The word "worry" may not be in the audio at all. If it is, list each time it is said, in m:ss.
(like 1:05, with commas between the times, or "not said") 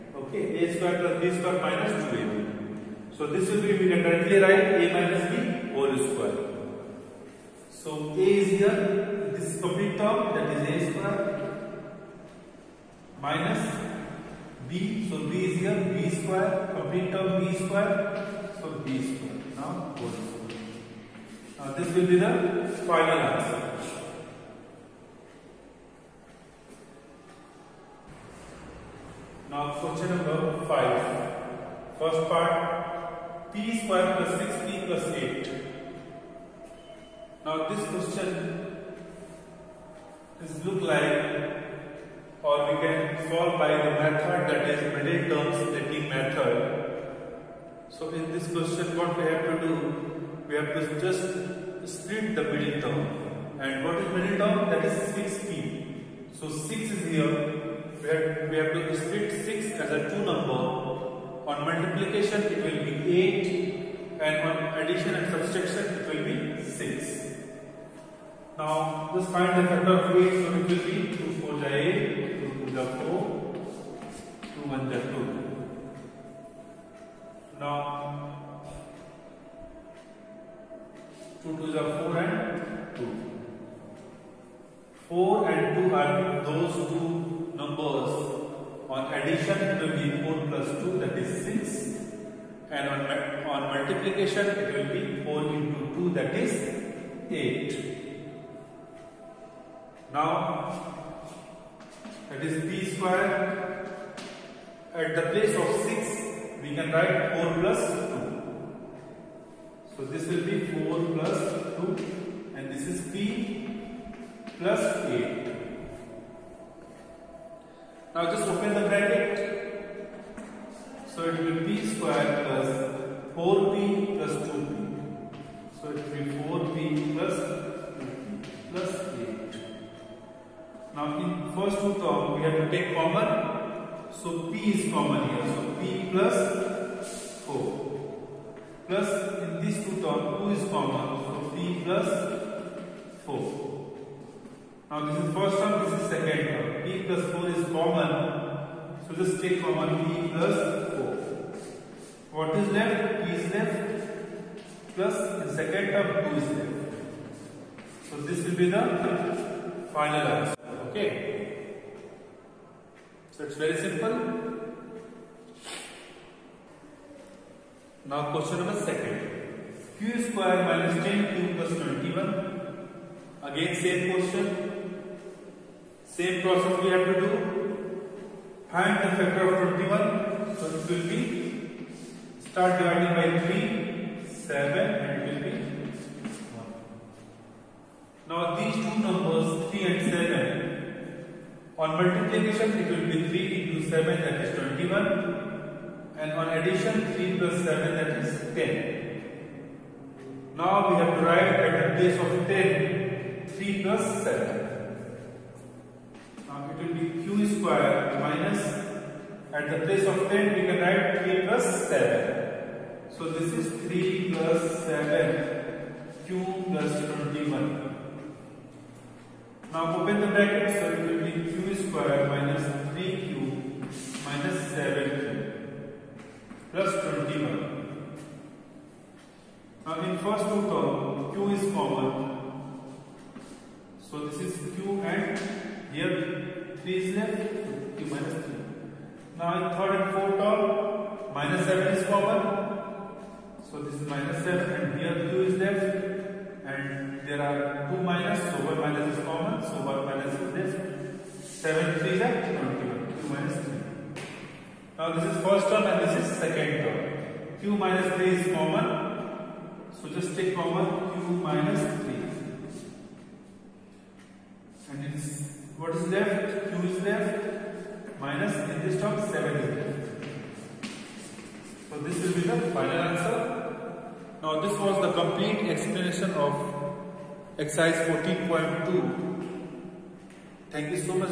not said.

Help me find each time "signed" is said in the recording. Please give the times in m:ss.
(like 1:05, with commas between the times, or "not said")
not said.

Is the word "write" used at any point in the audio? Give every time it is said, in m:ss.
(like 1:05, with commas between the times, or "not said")
0:04, 1:46, 3:21, 3:30.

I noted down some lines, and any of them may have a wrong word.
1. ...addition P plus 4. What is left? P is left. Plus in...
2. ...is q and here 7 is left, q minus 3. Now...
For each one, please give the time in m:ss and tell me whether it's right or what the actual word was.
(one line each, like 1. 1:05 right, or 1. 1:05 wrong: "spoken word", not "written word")
1. 2:29 wrong: "common", not "addition"
2. 3:54 wrong: "3", not "7".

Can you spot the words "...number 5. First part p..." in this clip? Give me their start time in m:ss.
0:30.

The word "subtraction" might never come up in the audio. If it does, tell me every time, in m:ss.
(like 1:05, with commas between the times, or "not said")
1:05.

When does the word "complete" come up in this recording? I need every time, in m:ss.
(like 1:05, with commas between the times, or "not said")
0:09, 0:16, 4:35.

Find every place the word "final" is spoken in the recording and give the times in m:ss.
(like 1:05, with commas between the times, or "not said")
0:22, 2:39, 4:32.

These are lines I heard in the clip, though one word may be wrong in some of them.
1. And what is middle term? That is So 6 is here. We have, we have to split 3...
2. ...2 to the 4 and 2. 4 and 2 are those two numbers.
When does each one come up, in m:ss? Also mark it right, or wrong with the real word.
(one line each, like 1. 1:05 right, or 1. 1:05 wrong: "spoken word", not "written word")
1. 0:53 wrong: "6", not "3"
2. 1:21 right.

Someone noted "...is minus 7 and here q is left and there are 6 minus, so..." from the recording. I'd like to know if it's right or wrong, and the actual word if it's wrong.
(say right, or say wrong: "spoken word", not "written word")
wrong: "2", not "6".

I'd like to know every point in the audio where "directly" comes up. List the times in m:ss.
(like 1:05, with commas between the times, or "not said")
0:04.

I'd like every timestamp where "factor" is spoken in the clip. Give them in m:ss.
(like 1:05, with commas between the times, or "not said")
1:09, 2:59.